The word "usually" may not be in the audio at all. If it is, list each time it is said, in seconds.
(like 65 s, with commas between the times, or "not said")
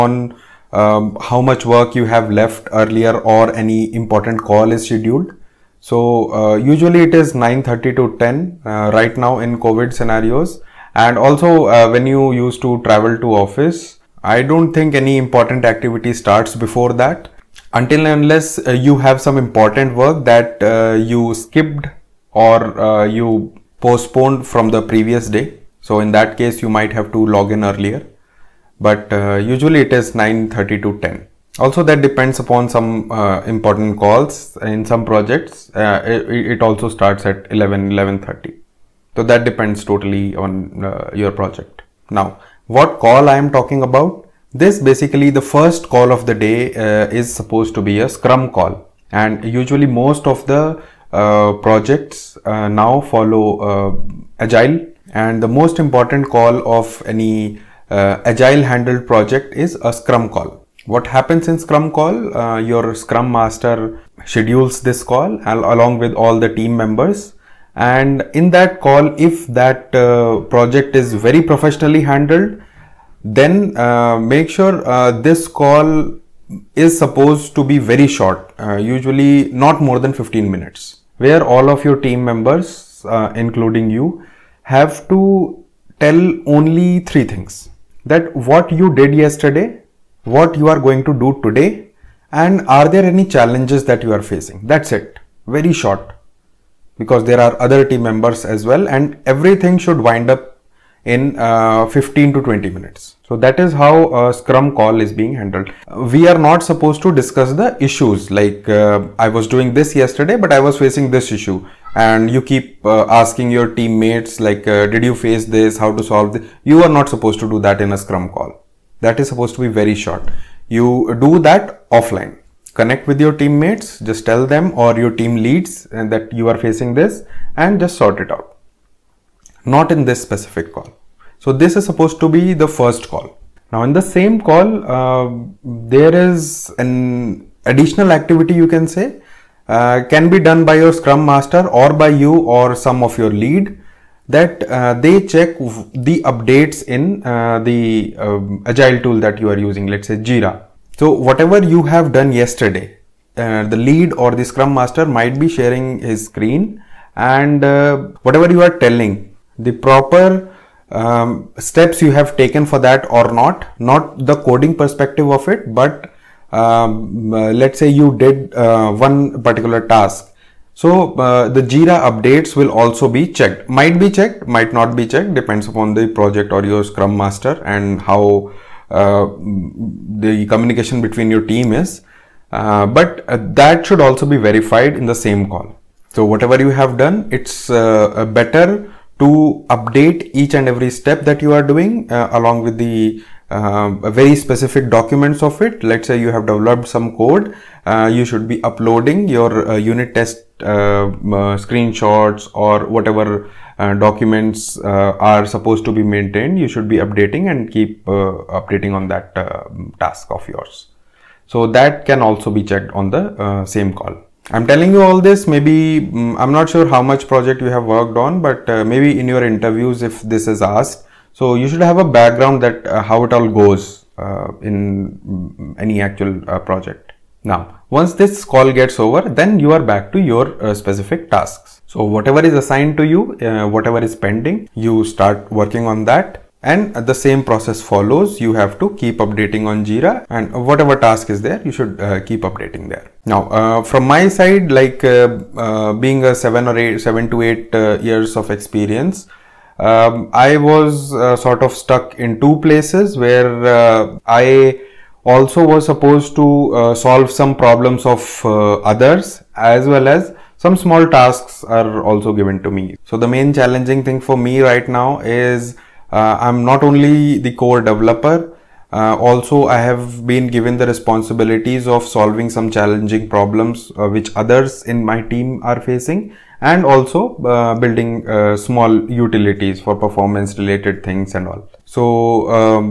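6 s, 29 s, 49 s, 78 s.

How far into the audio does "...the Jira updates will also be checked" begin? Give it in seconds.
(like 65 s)
171 s.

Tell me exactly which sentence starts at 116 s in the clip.
You are not supposed to do that in a scrum call.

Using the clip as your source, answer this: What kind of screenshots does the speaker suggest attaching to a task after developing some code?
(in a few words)
Unit test screenshots.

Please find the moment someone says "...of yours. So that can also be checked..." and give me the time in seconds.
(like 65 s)
210 s.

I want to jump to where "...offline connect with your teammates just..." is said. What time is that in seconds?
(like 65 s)
121 s.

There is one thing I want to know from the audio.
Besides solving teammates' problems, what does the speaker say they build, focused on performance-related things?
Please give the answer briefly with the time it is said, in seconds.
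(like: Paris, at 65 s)
Small utilities, at 278 s.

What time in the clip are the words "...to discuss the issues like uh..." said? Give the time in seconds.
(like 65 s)
107 s.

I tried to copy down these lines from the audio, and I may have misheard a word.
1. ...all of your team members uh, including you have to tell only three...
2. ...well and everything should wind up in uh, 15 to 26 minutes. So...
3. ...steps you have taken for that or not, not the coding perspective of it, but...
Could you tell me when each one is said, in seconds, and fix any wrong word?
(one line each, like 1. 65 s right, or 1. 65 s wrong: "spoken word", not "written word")
1. 81 s right
2. 98 s wrong: "20", not "26"
3. 161 s right.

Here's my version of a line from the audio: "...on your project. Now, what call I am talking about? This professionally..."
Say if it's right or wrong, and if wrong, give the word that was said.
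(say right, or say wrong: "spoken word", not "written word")
wrong: "basically", not "professionally".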